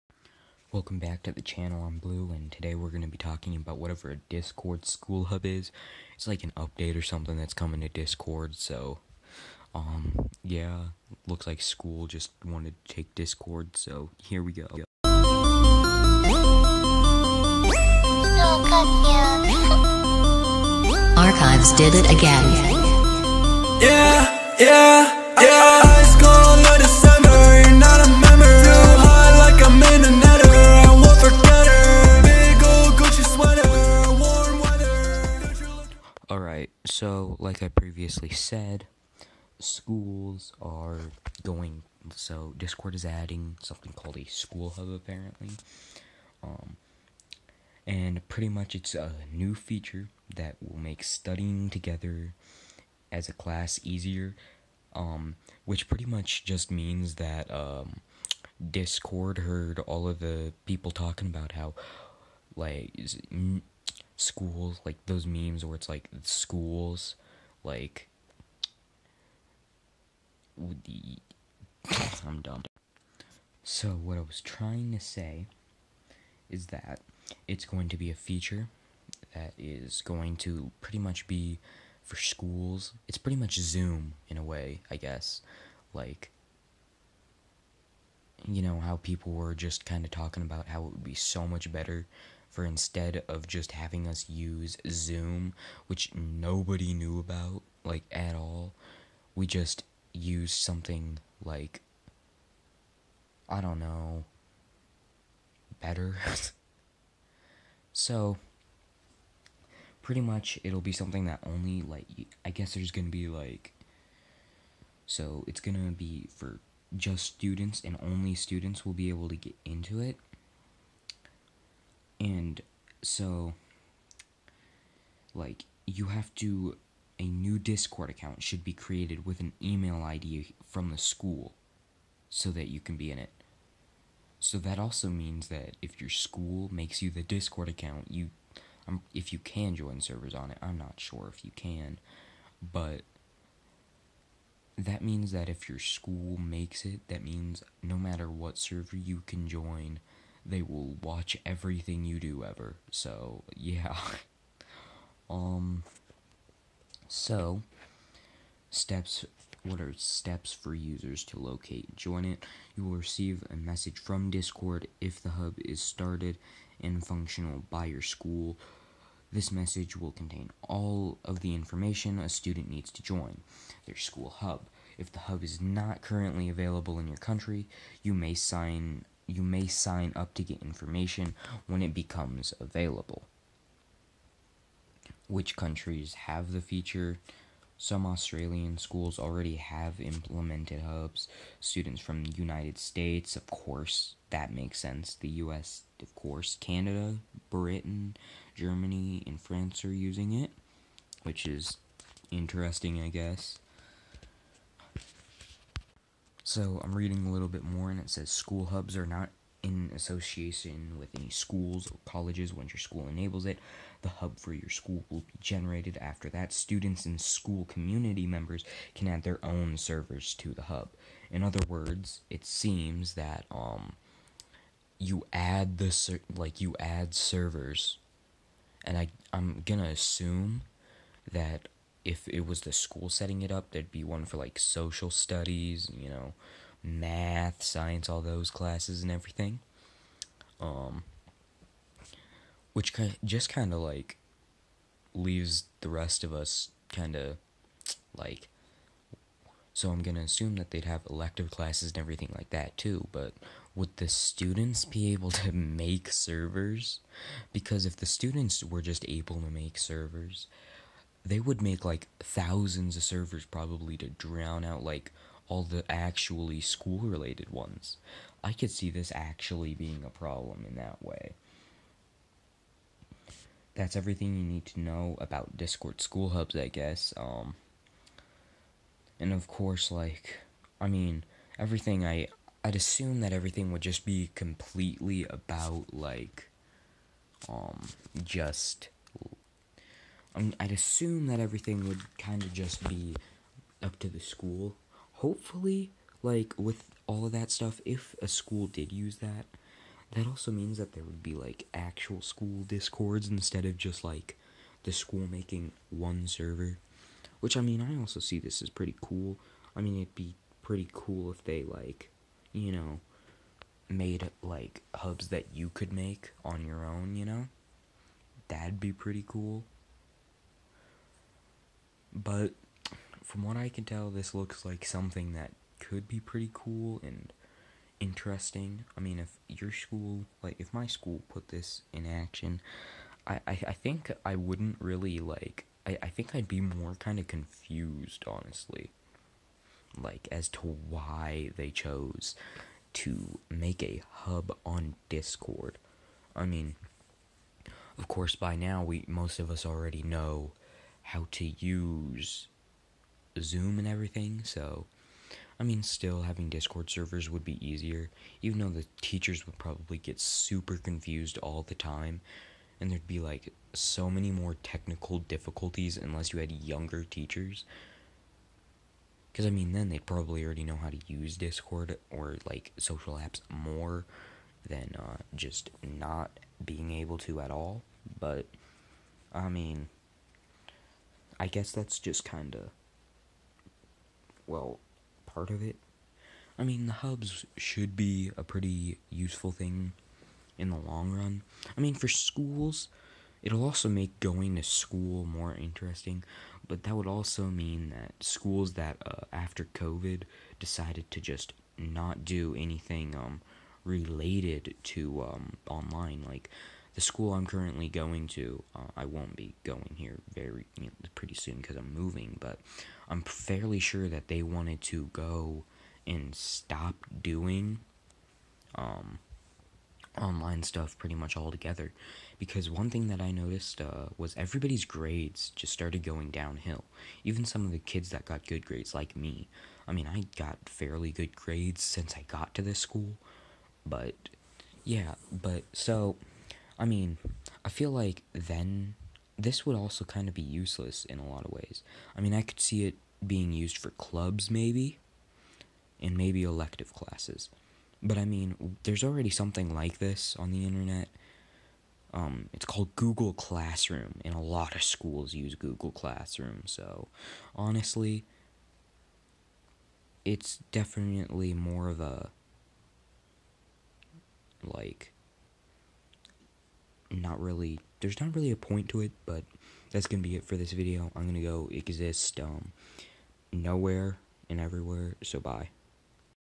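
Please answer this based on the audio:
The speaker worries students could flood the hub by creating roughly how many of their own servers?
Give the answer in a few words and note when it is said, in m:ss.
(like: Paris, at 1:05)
thousands, at 4:22.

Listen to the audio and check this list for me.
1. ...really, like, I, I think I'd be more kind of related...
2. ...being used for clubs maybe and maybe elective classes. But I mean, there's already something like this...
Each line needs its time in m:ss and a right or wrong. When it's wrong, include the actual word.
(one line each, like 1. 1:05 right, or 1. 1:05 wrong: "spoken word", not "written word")
1. 5:34 wrong: "confused", not "related"
2. 7:23 right.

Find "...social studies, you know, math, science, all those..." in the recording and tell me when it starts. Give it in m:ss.
3:54.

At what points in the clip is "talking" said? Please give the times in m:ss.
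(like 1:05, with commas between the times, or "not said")
0:03, 1:00, 1:30.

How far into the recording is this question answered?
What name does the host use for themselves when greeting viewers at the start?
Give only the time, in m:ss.
0:01.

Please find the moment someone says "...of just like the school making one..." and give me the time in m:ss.
5:03.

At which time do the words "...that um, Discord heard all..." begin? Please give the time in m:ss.
0:57.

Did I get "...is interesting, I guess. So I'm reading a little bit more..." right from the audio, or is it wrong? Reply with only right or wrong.
right.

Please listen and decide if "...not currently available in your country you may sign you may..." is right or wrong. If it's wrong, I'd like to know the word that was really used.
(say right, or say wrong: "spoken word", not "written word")
right.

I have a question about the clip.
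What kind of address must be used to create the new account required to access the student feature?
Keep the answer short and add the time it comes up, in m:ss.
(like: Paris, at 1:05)
email ID from the school, at 2:09.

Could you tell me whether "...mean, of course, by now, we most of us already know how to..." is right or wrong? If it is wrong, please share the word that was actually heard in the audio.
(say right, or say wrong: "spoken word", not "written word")
right.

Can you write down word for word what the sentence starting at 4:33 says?
That's everything you need to know about Discord school hubs, I guess.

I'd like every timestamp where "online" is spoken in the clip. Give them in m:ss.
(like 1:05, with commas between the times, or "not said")
6:45, 7:00.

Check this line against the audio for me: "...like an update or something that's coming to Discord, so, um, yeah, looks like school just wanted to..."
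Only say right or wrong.
right.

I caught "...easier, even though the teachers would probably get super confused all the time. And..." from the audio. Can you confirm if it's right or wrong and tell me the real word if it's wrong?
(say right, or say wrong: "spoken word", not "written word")
right.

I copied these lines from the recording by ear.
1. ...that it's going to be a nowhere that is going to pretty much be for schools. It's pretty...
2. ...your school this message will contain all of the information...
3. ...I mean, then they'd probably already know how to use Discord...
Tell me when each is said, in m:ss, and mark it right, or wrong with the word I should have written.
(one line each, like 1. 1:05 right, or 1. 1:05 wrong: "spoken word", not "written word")
1. 1:16 wrong: "feature", not "nowhere"
2. 2:47 right
3. 6:09 right.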